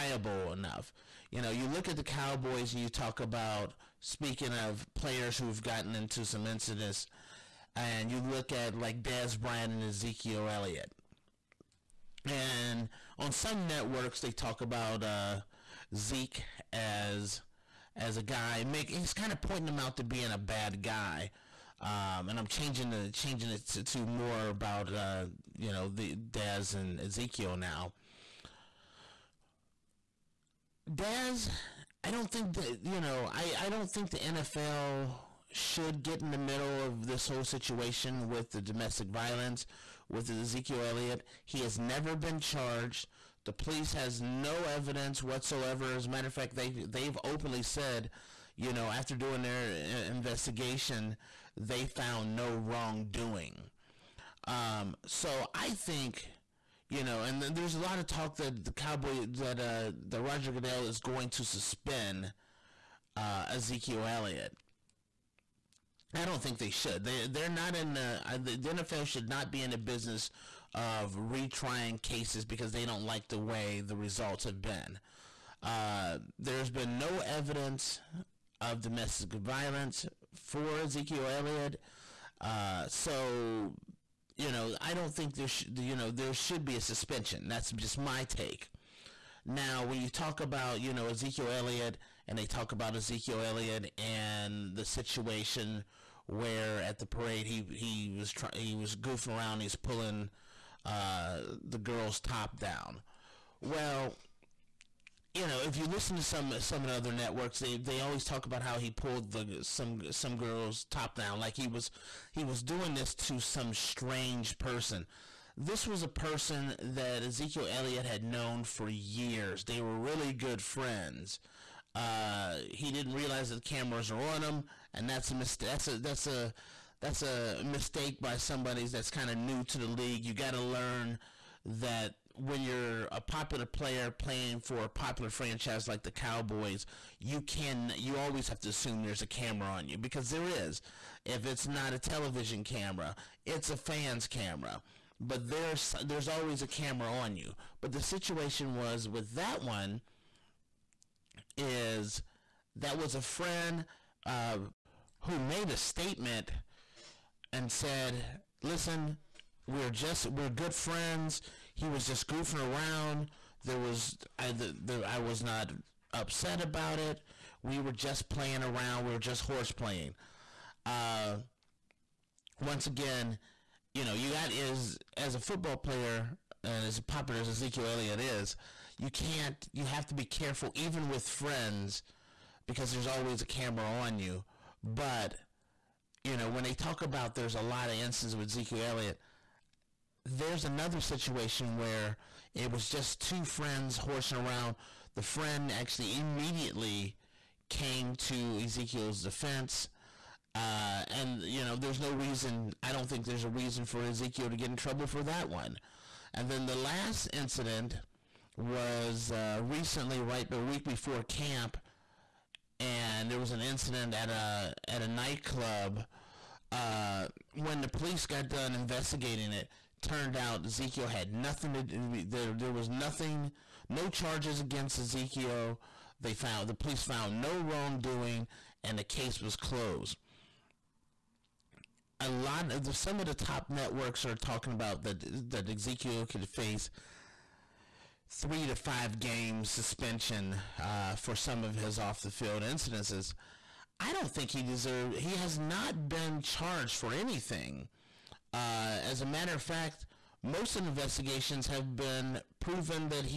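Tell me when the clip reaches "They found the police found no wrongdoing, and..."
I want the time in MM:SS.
03:46.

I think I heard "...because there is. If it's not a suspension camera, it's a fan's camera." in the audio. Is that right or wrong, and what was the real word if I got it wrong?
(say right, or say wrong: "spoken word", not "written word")
wrong: "television", not "suspension".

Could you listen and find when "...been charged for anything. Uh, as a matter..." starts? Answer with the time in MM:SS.
04:06.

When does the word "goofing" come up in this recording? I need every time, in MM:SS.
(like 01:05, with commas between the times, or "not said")
01:38, 02:42.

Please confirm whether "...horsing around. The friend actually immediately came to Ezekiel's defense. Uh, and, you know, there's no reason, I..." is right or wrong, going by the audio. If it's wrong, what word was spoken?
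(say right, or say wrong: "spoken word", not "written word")
right.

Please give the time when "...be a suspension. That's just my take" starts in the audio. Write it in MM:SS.
01:26.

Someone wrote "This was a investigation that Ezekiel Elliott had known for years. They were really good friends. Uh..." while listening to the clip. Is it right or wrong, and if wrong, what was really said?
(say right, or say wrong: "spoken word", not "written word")
wrong: "person", not "investigation".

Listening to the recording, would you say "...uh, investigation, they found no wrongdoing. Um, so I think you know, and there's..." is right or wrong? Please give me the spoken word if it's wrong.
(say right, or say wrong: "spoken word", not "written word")
right.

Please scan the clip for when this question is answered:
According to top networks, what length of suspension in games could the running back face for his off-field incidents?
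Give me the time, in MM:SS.
03:58.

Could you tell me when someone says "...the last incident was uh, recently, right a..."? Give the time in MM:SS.
03:26.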